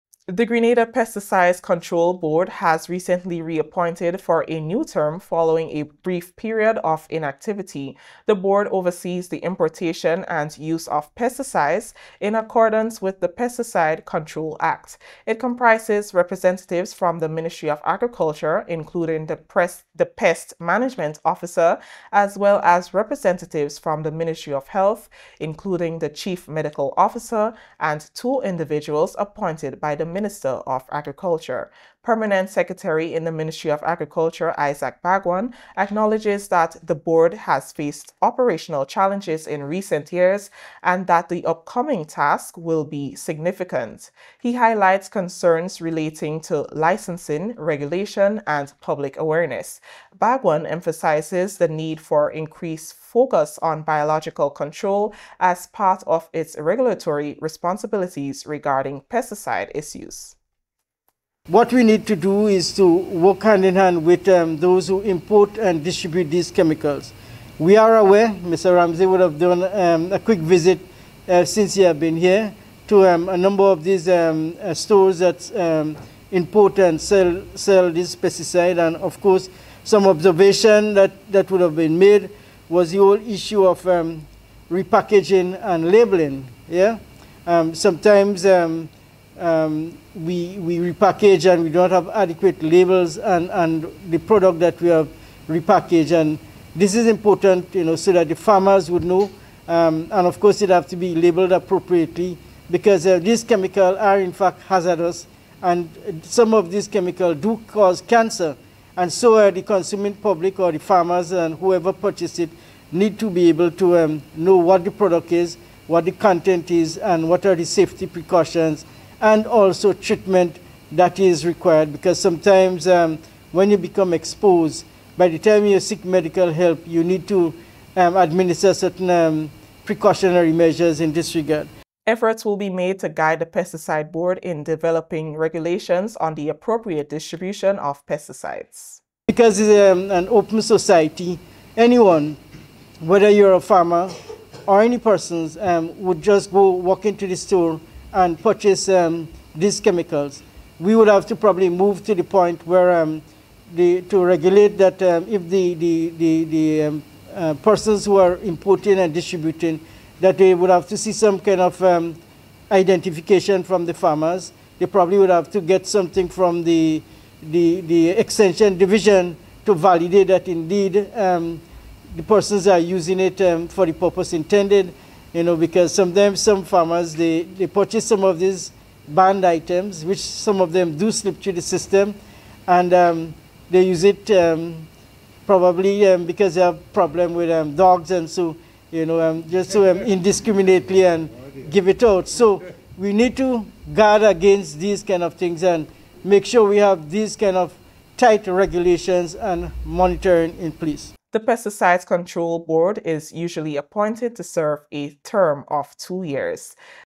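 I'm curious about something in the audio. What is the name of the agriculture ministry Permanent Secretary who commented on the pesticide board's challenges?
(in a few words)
Isaac Bhagwan.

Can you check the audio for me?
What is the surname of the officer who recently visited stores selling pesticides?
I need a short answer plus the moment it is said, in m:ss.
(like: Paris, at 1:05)
Mr. Ramsey, at 1:08.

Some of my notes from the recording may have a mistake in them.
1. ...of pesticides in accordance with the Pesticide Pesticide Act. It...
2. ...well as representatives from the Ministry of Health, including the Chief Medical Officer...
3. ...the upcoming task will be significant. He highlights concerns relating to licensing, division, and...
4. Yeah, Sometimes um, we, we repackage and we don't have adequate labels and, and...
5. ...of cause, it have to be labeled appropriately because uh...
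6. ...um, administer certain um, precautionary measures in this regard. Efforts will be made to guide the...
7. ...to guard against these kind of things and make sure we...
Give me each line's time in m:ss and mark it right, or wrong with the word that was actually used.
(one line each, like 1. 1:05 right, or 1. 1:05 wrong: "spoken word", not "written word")
1. 0:10 wrong: "Control", not "Pesticide"
2. 0:22 right
3. 0:41 wrong: "regulation", not "division"
4. 1:26 right
5. 1:40 wrong: "course", not "cause"
6. 2:07 right
7. 3:13 right.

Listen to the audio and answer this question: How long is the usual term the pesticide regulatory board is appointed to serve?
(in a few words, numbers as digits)
2 years.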